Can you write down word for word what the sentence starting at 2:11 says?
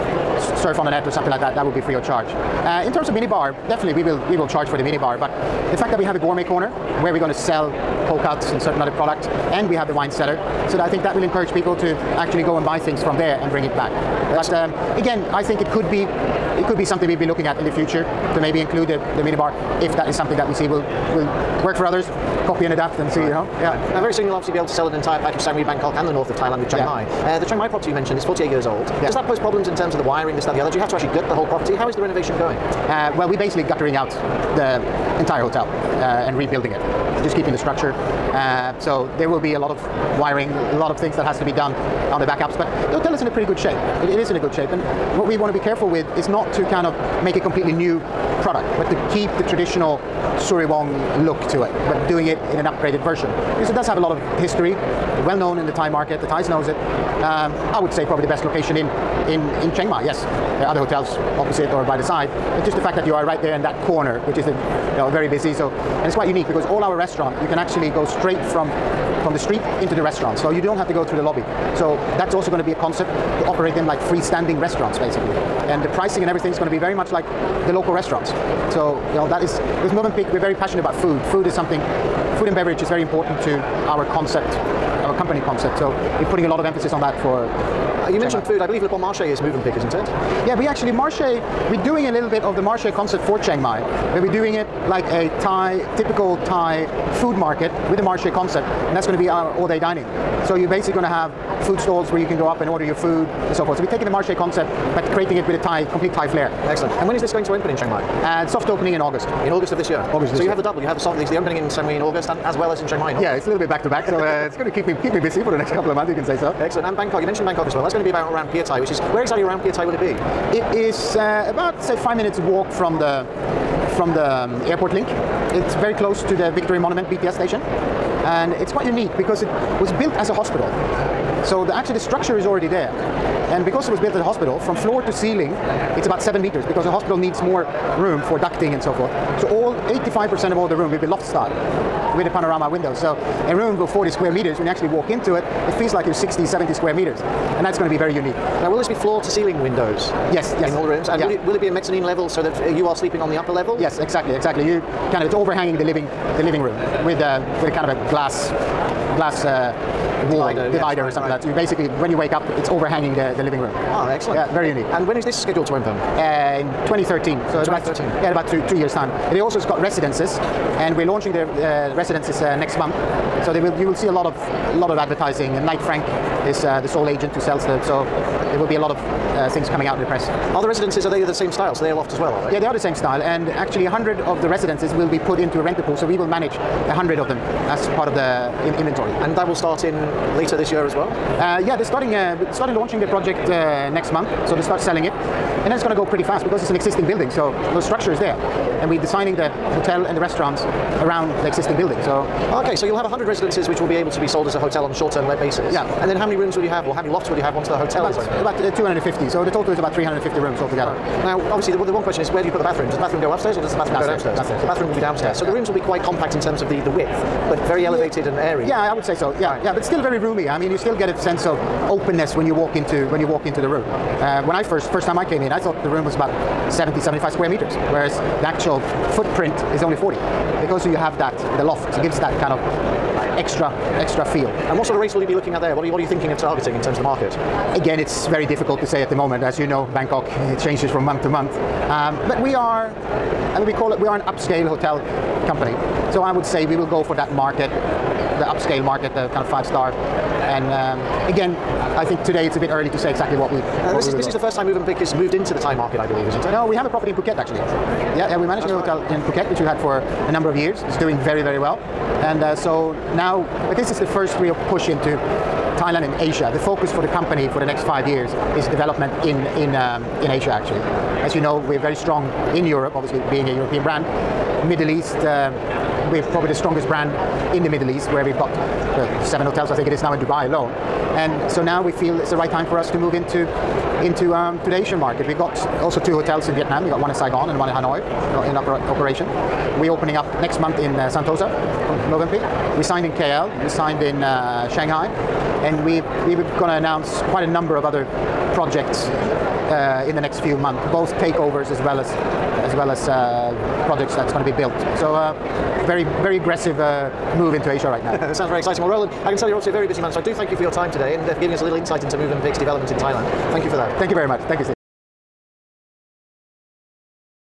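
So the, actually the structure is already there.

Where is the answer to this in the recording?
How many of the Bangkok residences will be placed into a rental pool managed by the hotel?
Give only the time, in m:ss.
3:03.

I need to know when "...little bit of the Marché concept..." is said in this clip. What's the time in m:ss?
1:32.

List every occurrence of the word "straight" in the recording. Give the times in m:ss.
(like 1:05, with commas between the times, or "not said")
1:08.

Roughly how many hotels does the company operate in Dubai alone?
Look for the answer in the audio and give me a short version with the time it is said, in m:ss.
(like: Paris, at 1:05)
7, at 4:39.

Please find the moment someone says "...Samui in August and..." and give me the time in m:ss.
1:51.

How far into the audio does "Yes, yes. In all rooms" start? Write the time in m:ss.
2:30.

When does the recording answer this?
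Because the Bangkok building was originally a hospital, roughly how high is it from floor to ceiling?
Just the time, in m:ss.
2:16.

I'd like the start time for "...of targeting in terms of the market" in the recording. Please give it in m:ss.
3:56.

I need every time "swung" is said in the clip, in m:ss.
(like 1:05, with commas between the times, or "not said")
not said.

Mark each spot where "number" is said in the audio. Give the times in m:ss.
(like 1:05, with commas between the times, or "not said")
4:20, 4:57.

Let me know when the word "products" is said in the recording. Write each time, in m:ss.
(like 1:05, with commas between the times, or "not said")
0:08, 0:48.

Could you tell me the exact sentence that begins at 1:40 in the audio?
So you're basically going to have food stalls where you can go up and order your food and so forth.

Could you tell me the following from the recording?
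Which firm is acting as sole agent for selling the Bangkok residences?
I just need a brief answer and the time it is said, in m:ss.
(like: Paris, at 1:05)
Knight Frank, at 2:55.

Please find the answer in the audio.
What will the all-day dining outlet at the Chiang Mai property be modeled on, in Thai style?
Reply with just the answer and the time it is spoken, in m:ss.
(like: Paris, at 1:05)
Typical Thai food market, at 1:35.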